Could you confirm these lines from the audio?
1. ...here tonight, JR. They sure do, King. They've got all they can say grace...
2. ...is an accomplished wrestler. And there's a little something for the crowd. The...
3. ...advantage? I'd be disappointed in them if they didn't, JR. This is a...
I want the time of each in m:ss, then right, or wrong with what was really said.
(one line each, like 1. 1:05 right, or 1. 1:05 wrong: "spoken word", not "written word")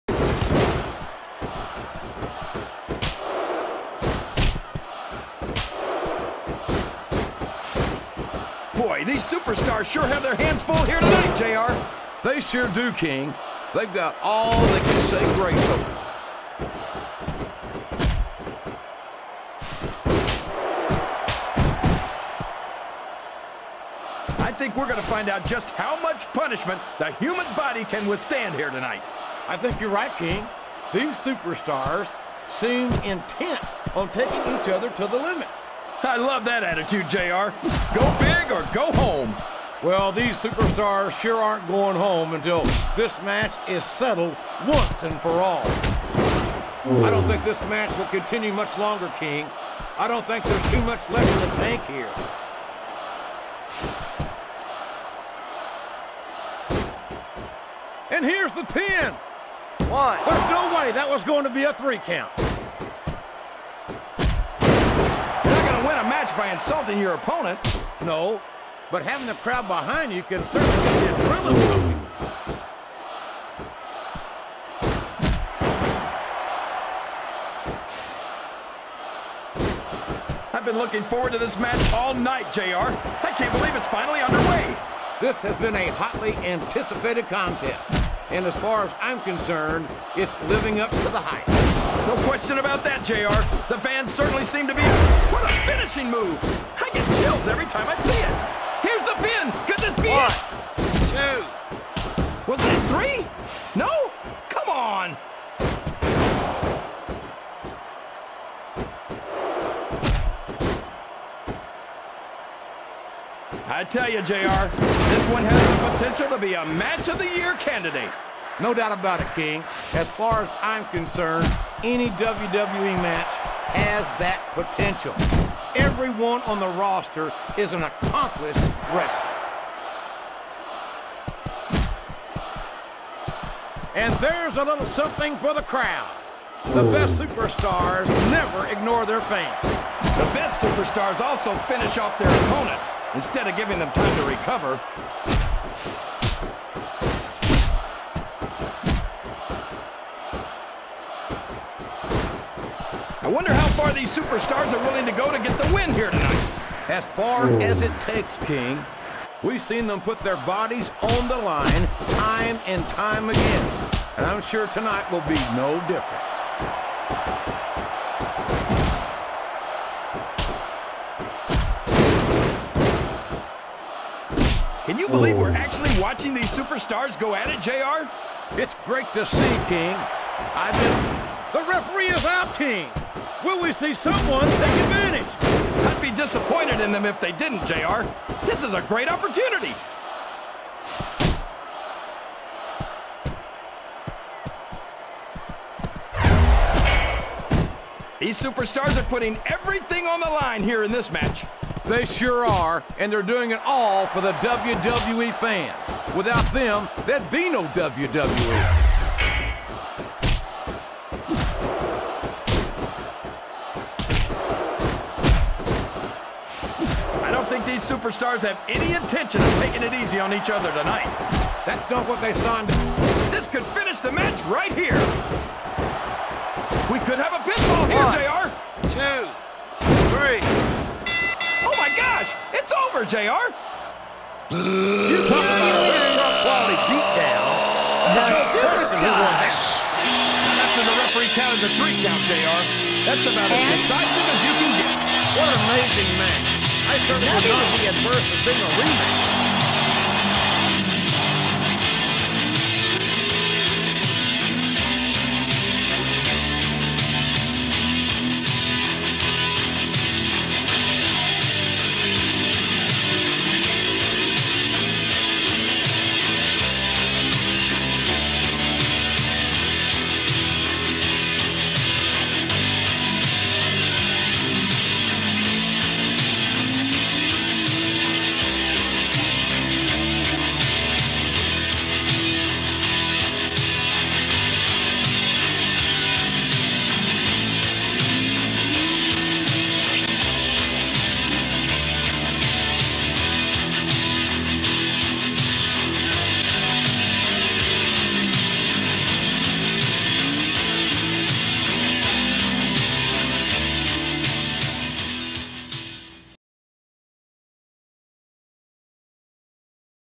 1. 0:10 right
2. 2:07 right
3. 3:04 right.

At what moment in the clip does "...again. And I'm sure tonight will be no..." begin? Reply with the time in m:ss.
2:43.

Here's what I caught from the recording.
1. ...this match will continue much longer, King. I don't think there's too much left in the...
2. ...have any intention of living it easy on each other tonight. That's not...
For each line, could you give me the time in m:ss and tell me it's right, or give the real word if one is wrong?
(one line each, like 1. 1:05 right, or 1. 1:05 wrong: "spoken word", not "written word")
1. 0:47 right
2. 3:38 wrong: "taking", not "living".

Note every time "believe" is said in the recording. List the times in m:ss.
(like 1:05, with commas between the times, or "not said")
1:23, 2:55.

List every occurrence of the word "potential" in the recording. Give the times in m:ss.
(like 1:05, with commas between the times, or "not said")
1:55, 2:04.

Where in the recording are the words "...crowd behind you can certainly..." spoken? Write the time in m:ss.
1:09.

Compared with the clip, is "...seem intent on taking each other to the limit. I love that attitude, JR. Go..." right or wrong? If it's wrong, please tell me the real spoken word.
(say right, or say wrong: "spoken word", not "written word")
right.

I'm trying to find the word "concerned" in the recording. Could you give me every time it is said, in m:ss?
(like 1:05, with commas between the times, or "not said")
1:29, 2:00.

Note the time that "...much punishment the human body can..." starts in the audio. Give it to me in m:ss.
0:26.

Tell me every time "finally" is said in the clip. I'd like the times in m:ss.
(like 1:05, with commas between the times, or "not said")
1:23.